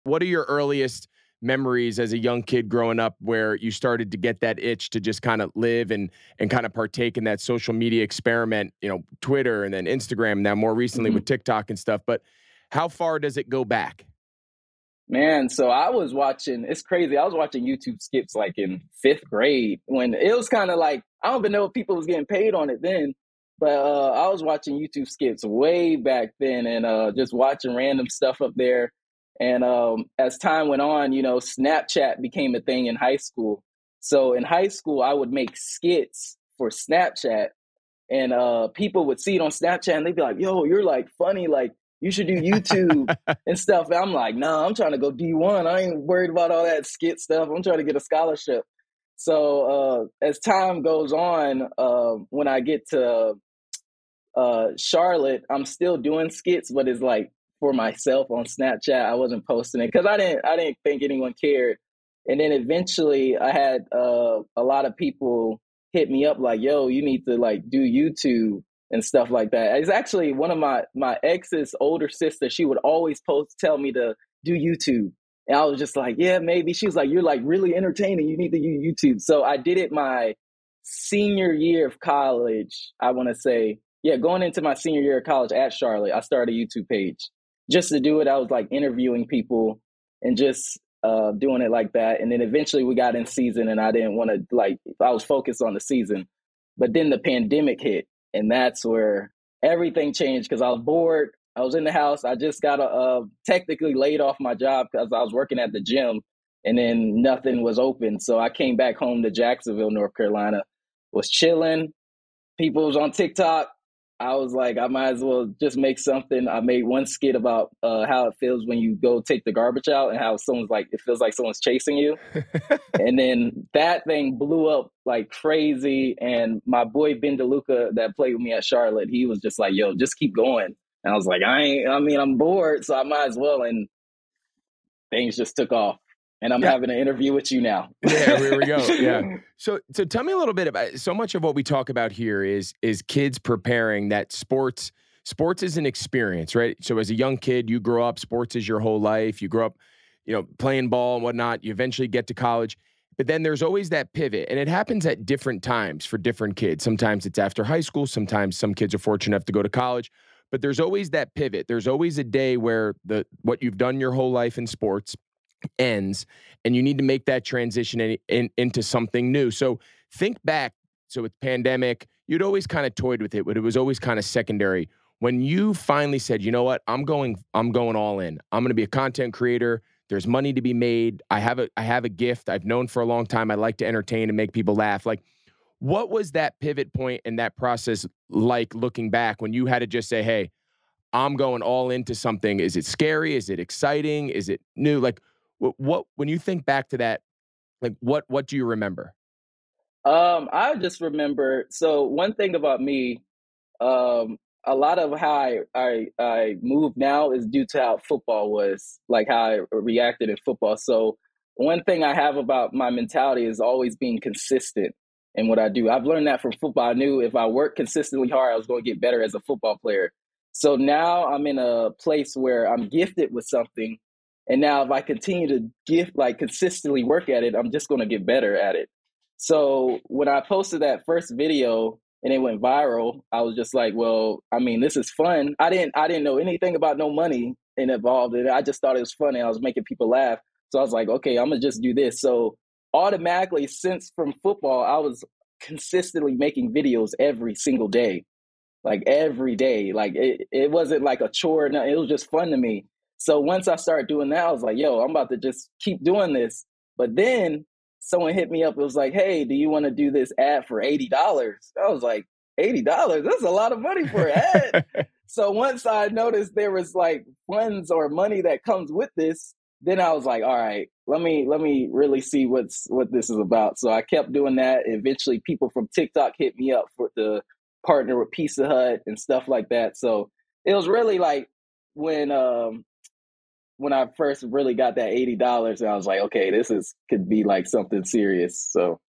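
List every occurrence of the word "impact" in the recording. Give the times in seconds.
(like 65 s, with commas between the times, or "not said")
not said.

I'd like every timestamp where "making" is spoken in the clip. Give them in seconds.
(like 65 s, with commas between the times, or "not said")
239 s, 246 s.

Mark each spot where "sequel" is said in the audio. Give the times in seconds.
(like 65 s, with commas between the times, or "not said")
not said.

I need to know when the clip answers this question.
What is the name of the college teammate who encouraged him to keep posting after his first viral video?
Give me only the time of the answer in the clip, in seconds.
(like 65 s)
127 s.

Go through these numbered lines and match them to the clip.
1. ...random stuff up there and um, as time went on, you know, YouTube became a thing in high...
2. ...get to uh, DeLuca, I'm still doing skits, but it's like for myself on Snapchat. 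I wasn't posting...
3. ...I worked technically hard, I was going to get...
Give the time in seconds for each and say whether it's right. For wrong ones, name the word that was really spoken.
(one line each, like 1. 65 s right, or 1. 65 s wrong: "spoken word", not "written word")
1. 27 s wrong: "Snapchat", not "YouTube"
2. 52 s wrong: "Charlotte", not "DeLuca"
3. 217 s wrong: "consistently", not "technically".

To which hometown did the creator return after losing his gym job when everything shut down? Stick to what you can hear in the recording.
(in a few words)
Jacksonville, North Carolina.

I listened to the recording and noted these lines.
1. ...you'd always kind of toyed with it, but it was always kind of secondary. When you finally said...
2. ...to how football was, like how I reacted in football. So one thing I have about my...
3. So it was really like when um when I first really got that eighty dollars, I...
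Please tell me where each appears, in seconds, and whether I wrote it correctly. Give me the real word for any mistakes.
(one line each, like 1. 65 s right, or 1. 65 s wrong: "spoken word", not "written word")
1. 172 s right
2. 207 s right
3. 279 s right.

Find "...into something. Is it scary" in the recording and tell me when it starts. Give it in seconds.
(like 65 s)
191 s.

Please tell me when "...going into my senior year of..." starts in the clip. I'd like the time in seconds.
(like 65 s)
84 s.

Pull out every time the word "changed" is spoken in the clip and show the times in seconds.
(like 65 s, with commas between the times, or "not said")
100 s.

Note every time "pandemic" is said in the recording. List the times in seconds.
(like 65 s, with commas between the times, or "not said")
97 s, 171 s.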